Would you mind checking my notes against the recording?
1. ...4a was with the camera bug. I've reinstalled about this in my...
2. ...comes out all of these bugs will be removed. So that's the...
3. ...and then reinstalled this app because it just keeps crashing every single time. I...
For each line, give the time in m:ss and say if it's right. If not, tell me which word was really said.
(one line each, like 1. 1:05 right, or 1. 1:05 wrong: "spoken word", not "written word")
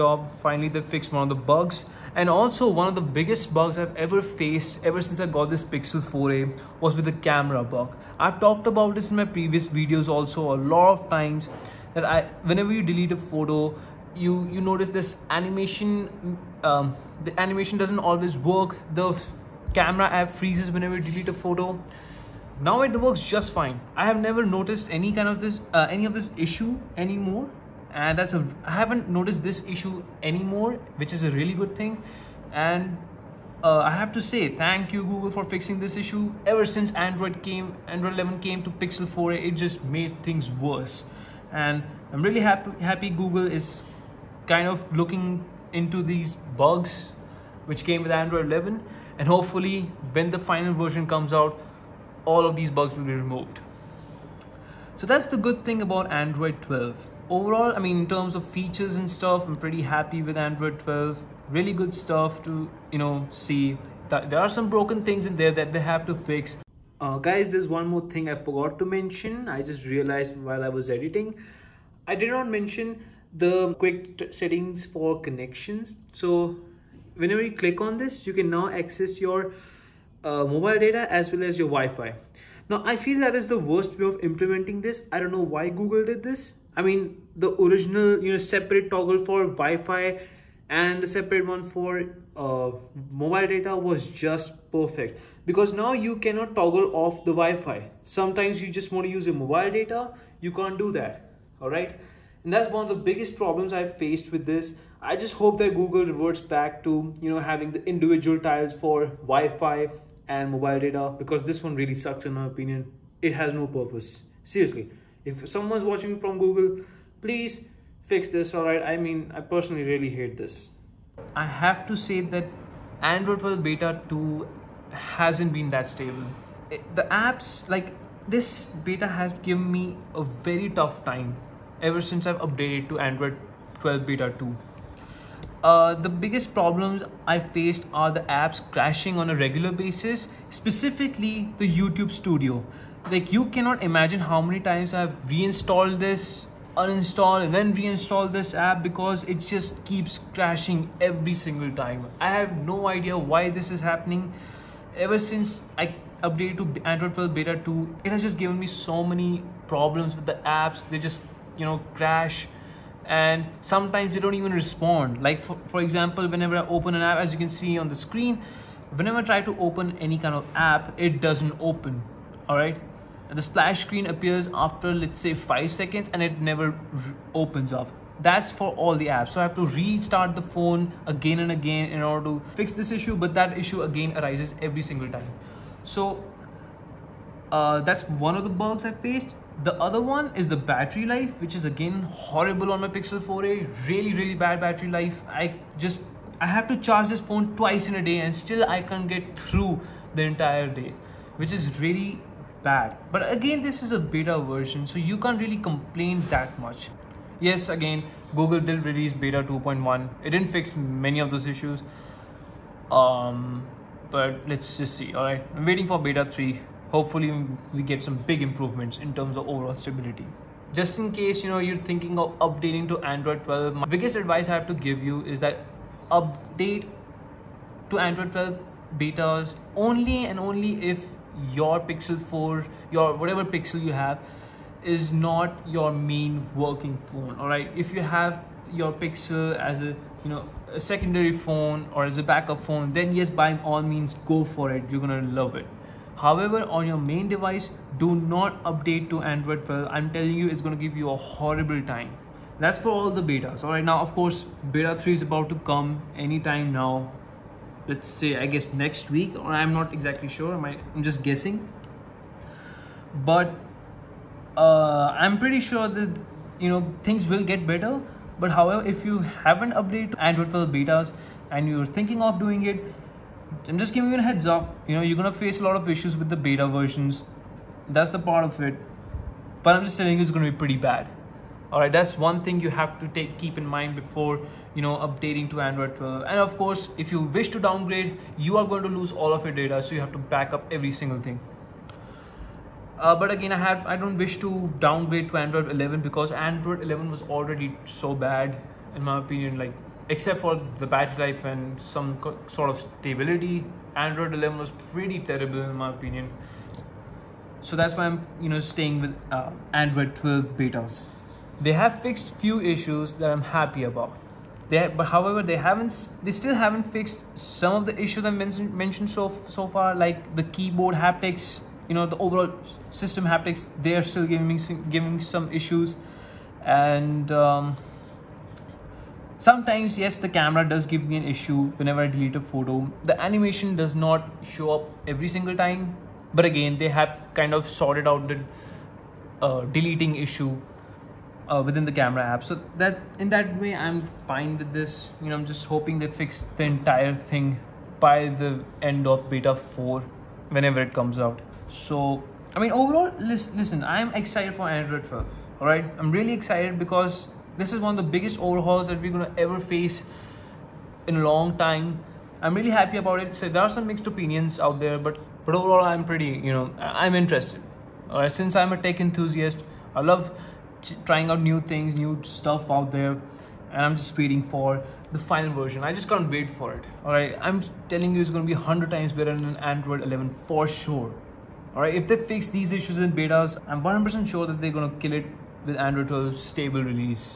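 1. 0:06 wrong: "talked", not "reinstalled"
2. 0:51 right
3. 2:27 right.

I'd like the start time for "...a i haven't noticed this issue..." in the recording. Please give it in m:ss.
0:28.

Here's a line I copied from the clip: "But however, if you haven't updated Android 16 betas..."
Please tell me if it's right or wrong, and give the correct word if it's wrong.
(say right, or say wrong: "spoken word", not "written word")
wrong: "12", not "16".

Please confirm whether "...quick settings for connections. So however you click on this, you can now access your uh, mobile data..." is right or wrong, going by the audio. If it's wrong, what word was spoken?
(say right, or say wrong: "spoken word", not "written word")
wrong: "whenever", not "however".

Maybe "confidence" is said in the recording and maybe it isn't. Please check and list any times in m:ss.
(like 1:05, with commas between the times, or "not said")
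not said.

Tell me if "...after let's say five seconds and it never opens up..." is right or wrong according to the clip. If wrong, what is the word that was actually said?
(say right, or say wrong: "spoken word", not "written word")
right.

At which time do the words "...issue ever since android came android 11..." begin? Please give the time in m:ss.
0:35.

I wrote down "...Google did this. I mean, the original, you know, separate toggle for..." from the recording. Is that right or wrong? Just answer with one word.
right.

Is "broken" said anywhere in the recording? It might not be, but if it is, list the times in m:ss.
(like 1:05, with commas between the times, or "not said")
1:04.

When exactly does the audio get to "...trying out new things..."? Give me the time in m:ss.
6:11.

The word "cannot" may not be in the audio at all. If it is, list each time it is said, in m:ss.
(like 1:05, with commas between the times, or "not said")
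1:36, 2:23.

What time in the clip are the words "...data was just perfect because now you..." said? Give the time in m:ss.
1:33.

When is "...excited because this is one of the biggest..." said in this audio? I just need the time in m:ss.
5:56.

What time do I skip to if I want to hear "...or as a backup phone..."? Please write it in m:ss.
4:01.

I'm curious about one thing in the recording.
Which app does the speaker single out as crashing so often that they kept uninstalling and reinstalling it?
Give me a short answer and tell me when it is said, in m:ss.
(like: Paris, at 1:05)
YouTube Studio, at 2:21.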